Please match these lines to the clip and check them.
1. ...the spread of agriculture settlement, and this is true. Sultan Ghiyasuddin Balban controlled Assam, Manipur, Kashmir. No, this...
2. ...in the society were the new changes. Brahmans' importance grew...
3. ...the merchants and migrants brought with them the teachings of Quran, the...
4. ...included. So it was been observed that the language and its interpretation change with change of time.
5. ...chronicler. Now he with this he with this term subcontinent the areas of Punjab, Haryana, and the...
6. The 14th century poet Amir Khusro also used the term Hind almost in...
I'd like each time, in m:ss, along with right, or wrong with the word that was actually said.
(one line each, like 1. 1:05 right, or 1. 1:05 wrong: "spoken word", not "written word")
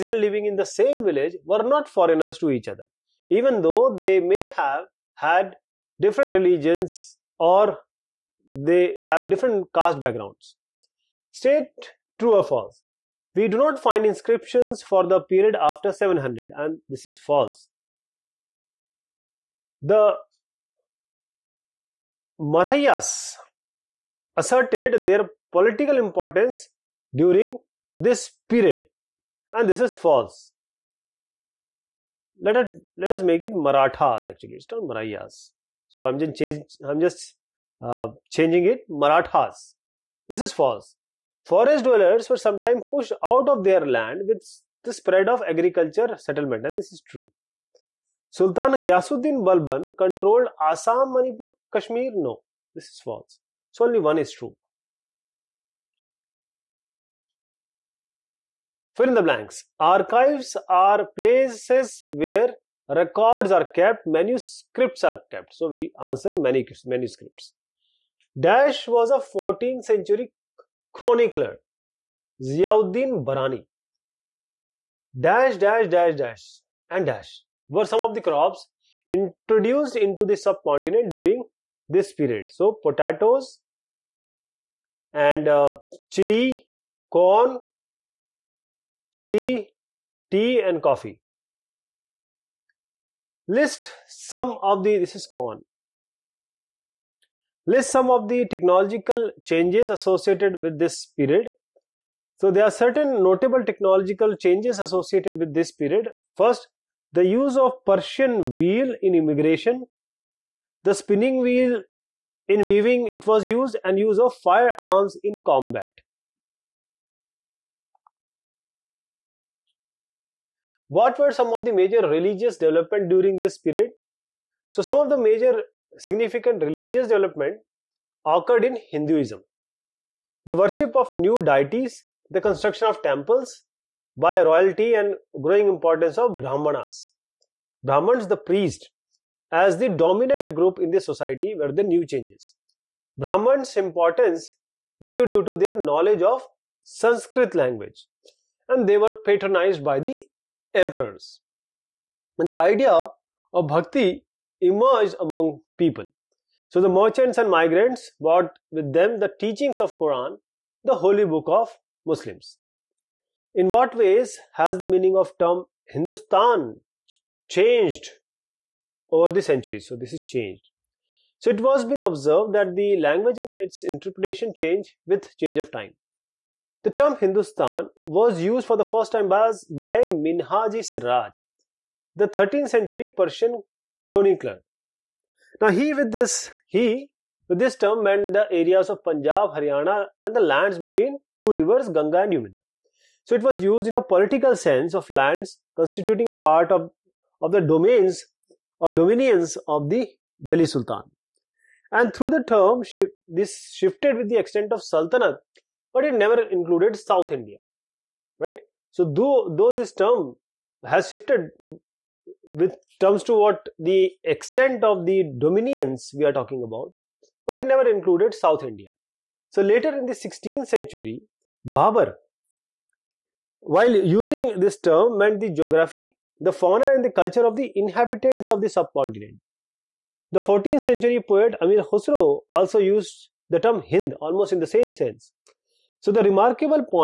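1. 0:44 right
2. 2:20 right
3. 2:36 right
4. 2:50 wrong: "changed", not "included"
5. 3:04 wrong: "meant", not "subcontinent"
6. 3:50 right.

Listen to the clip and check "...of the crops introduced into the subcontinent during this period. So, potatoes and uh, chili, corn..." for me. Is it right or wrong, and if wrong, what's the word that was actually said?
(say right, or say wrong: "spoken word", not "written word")
right.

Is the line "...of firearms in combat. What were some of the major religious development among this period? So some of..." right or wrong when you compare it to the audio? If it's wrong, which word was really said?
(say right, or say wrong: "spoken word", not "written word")
wrong: "during", not "among".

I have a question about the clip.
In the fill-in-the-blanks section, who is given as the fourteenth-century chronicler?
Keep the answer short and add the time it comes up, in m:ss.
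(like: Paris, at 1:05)
Ziauddin Barani, at 1:12.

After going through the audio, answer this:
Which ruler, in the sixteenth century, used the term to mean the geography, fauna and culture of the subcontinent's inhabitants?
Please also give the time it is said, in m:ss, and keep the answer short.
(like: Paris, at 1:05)
Babar, at 3:41.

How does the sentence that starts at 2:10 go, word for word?
The worship of new deities, the construction of temples by royalty and growing importance of Brahmanas.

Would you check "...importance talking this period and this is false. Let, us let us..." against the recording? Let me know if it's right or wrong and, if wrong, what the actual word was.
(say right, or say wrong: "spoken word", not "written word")
wrong: "during", not "talking".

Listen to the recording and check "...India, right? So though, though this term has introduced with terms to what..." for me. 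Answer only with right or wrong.
wrong.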